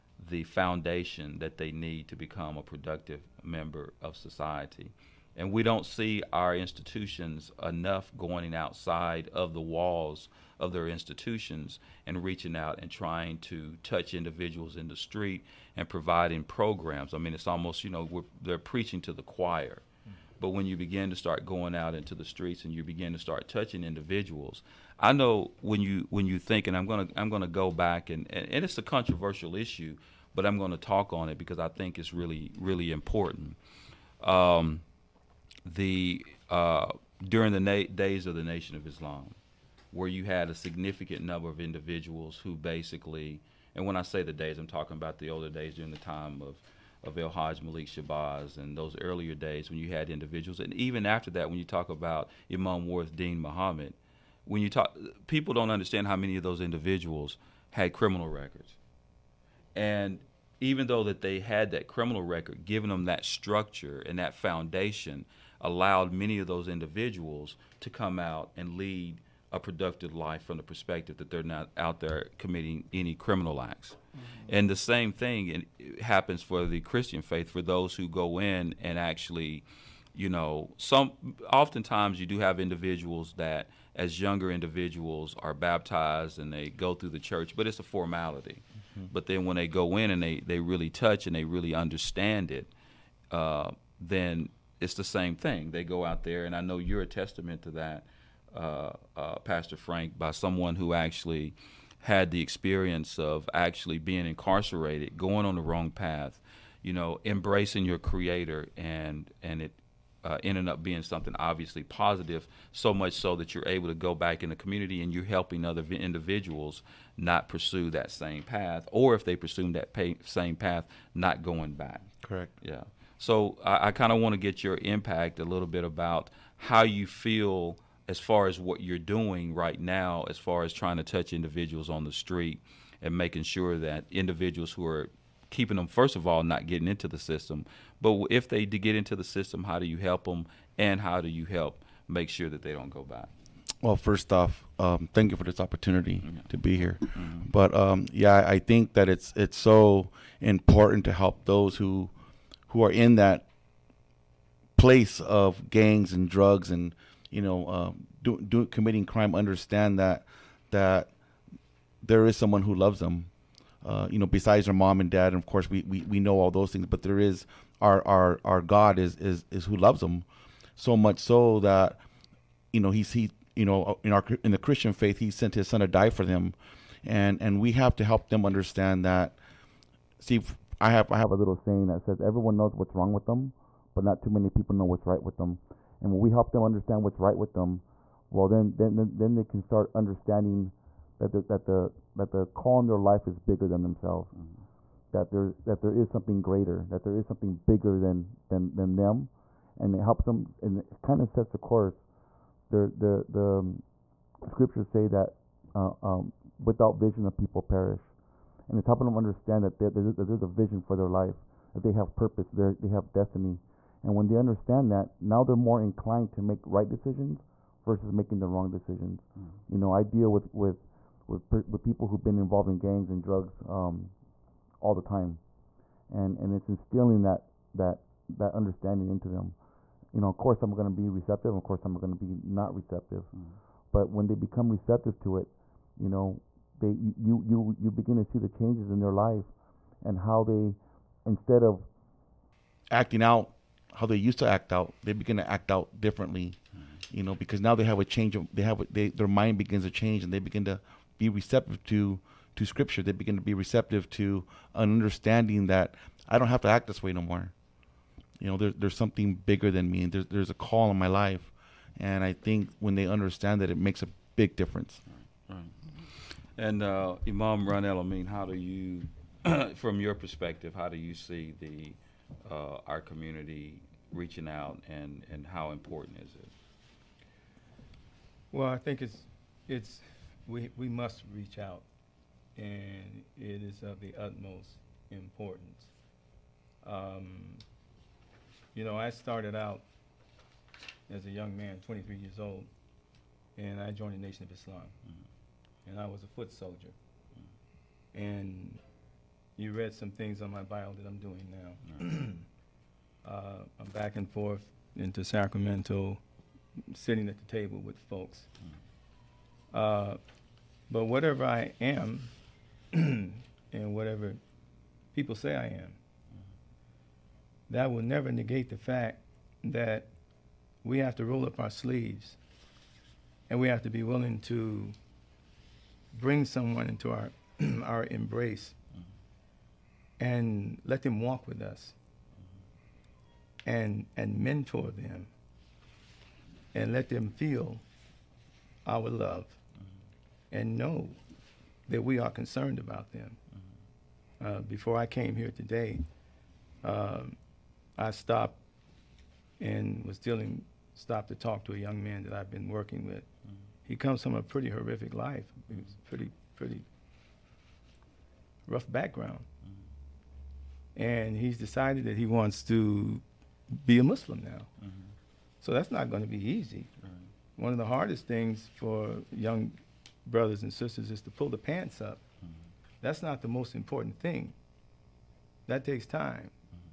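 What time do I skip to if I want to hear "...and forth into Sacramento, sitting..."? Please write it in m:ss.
5:04.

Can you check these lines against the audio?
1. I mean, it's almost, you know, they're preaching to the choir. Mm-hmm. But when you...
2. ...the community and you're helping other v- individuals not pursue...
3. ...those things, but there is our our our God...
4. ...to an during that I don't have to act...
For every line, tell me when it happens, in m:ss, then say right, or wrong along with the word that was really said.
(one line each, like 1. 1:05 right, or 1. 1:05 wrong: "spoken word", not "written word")
1. 0:17 right
2. 1:54 right
3. 2:46 right
4. 4:14 wrong: "understanding", not "during".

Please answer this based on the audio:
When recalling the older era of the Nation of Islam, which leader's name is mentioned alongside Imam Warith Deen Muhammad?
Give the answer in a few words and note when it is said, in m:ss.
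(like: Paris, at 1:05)
El Hajj Malik Shabazz, at 0:47.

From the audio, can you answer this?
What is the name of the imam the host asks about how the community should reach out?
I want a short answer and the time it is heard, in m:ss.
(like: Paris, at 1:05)
Ron El Amin, at 4:27.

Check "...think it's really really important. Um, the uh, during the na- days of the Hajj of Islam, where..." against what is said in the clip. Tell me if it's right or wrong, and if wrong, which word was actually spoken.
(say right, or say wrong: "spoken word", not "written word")
wrong: "Nation", not "Hajj".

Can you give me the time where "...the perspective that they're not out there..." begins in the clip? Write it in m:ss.
1:10.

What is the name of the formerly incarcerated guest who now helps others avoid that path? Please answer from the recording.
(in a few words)
Pastor Frank.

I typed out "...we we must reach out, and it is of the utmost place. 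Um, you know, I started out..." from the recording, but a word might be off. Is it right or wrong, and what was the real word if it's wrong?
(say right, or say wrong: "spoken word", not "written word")
wrong: "importance", not "place".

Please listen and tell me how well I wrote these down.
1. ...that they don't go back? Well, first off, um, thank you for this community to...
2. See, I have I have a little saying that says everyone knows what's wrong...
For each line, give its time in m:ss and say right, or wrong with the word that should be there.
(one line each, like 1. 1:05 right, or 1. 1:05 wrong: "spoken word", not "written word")
1. 2:22 wrong: "opportunity", not "community"
2. 3:00 right.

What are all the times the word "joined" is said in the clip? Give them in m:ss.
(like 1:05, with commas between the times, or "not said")
4:53.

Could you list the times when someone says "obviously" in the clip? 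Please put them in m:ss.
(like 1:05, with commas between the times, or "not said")
1:51.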